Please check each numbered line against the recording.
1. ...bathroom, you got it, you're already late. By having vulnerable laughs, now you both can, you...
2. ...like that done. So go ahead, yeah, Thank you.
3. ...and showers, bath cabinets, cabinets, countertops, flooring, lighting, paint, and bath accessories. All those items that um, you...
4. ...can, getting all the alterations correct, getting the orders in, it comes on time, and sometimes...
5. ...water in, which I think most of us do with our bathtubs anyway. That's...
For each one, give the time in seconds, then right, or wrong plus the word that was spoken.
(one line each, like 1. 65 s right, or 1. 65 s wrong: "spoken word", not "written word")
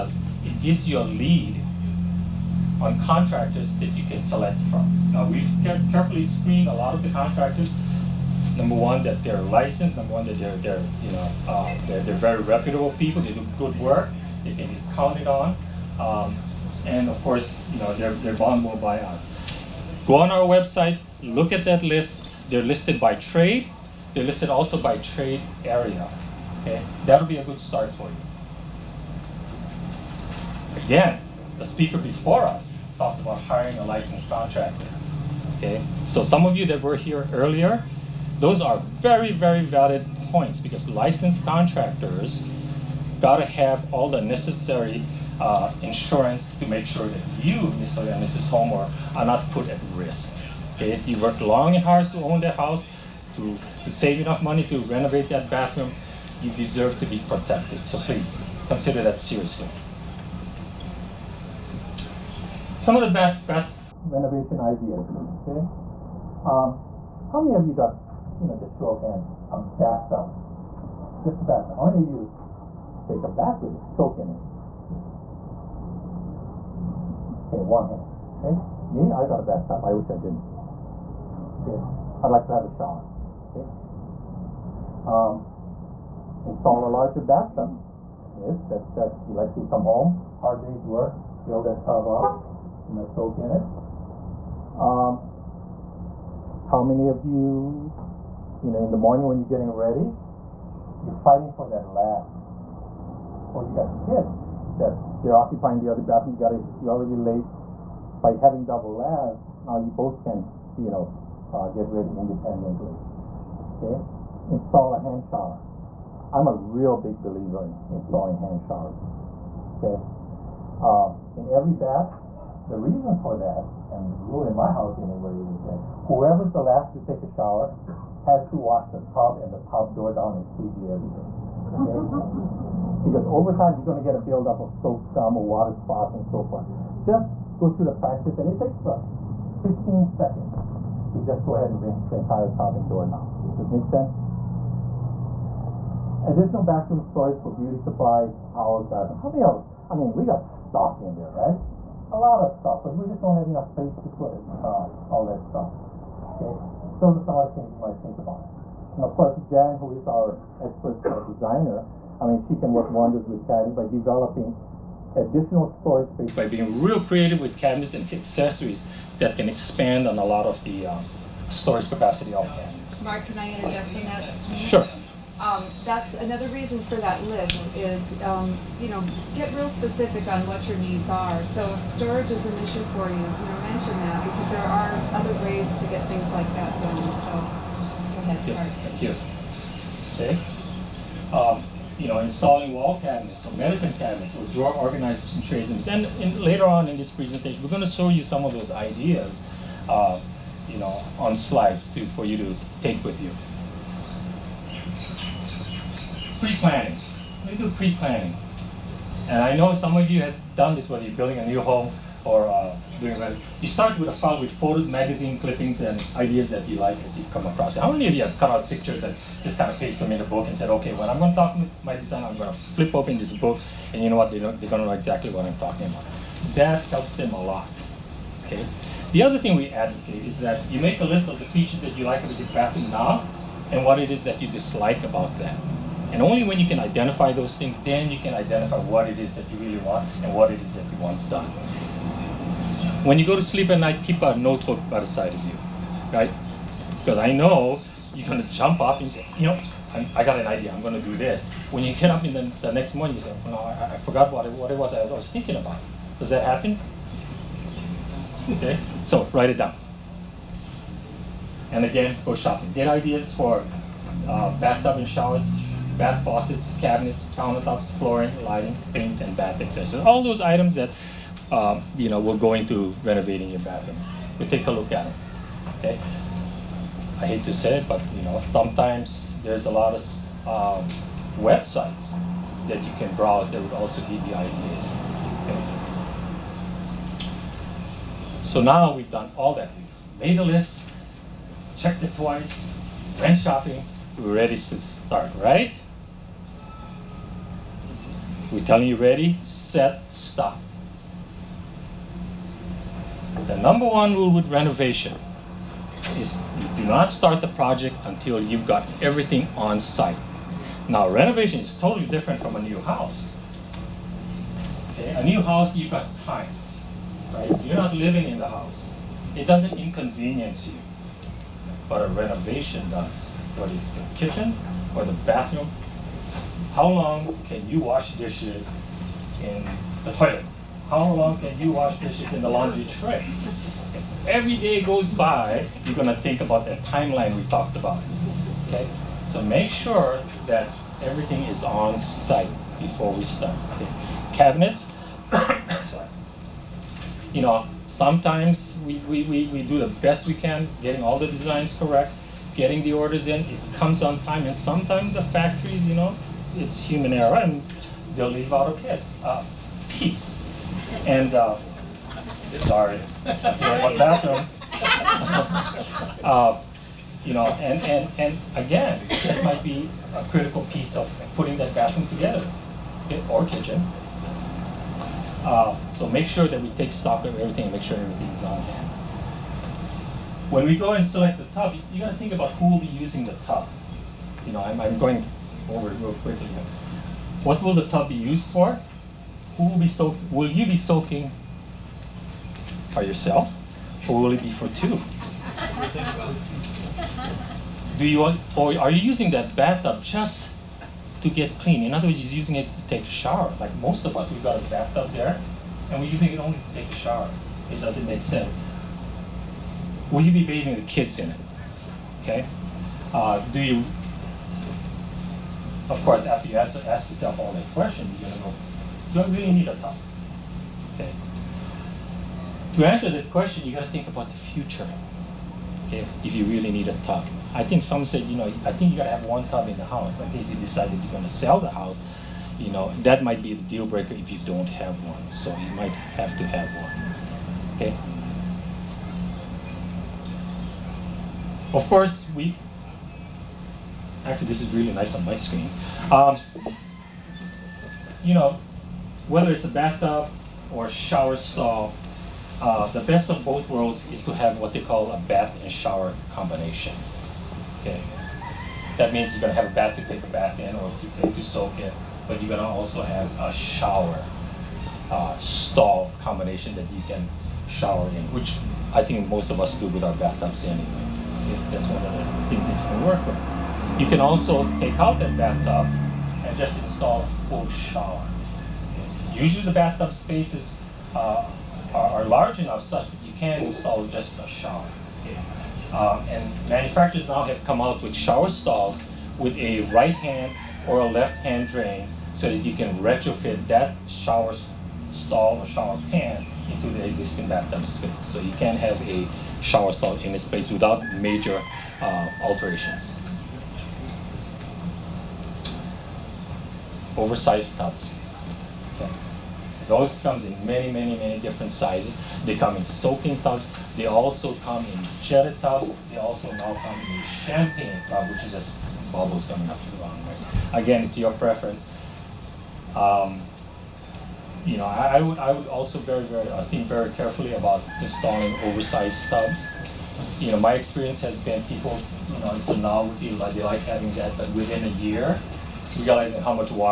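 1. 106 s wrong: "double", not "vulnerable"
2. 186 s right
3. 264 s wrong: "faucets", not "cabinets"
4. 350 s wrong: "designs", not "alterations"
5. 467 s wrong: "shower", not "water".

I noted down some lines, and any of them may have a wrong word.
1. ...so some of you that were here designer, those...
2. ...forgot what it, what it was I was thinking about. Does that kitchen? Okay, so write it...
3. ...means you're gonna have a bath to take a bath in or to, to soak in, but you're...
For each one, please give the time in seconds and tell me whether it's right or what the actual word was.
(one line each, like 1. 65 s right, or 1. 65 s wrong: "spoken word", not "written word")
1. 36 s wrong: "earlier", not "designer"
2. 254 s wrong: "happen", not "kitchen"
3. 459 s right.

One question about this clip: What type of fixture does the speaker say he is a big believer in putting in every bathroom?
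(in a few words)
Hand shower.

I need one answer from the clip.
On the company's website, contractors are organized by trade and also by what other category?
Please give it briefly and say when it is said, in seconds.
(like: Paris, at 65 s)
Trade area, at 24 s.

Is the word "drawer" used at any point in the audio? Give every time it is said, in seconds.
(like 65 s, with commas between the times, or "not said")
194 s.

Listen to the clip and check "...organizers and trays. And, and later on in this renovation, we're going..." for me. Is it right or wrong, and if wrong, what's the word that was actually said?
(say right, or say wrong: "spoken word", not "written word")
wrong: "presentation", not "renovation".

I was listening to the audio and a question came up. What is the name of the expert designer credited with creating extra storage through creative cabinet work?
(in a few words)
Jan.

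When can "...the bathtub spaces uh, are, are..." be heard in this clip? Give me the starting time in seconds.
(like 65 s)
479 s.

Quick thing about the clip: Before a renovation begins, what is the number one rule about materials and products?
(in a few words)
Everything on site.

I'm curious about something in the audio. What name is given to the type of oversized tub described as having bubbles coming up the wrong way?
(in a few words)
Champagne tub.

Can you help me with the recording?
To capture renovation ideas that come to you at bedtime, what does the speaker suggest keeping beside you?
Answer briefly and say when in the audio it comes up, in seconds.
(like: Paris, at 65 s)
A notebook, at 244 s.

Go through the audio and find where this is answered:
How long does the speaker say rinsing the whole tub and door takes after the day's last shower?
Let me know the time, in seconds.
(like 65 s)
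139 s.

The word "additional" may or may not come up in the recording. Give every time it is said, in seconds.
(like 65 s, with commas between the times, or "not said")
146 s, 165 s.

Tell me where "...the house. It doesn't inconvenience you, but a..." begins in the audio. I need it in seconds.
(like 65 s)
318 s.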